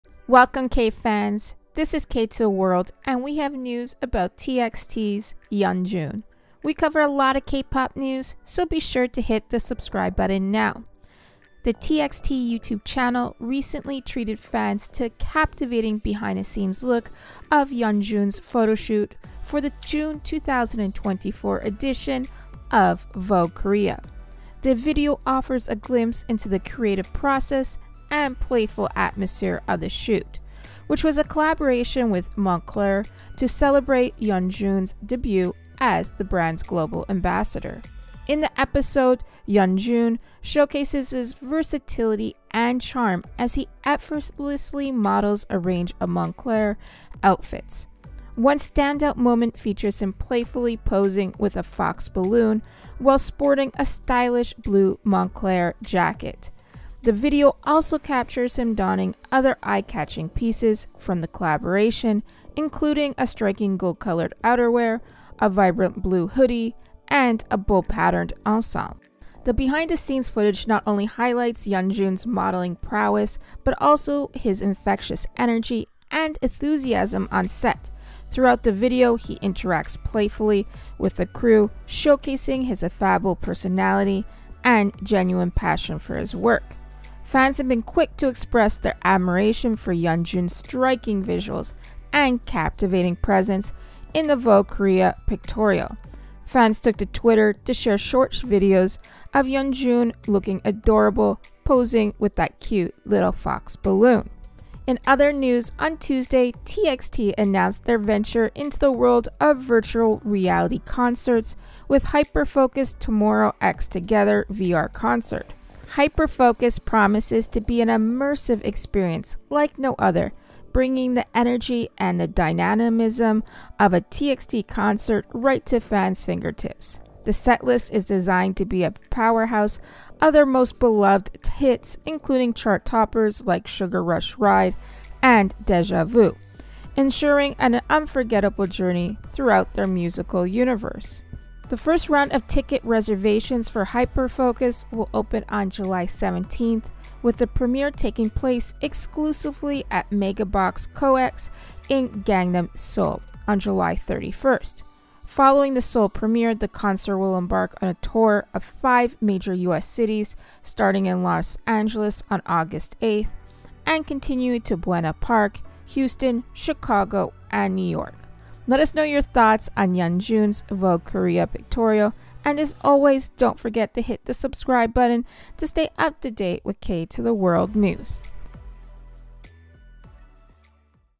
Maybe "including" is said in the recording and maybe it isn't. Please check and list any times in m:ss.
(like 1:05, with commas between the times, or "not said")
1:02, 2:12.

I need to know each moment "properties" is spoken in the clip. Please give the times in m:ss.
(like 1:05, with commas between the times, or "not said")
not said.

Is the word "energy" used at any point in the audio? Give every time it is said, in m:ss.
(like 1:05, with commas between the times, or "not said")
1:15, 2:01.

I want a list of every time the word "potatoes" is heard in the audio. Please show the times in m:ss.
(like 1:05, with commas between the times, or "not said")
not said.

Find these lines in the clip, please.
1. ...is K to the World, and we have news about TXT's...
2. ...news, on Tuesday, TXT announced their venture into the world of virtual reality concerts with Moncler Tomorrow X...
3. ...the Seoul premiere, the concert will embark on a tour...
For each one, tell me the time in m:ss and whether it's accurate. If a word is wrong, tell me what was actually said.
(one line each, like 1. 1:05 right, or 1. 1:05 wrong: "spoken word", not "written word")
1. 0:01 right
2. 1:45 wrong: "Hyperfocus", not "Moncler"
3. 2:35 right.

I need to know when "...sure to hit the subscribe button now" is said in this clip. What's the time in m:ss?
0:08.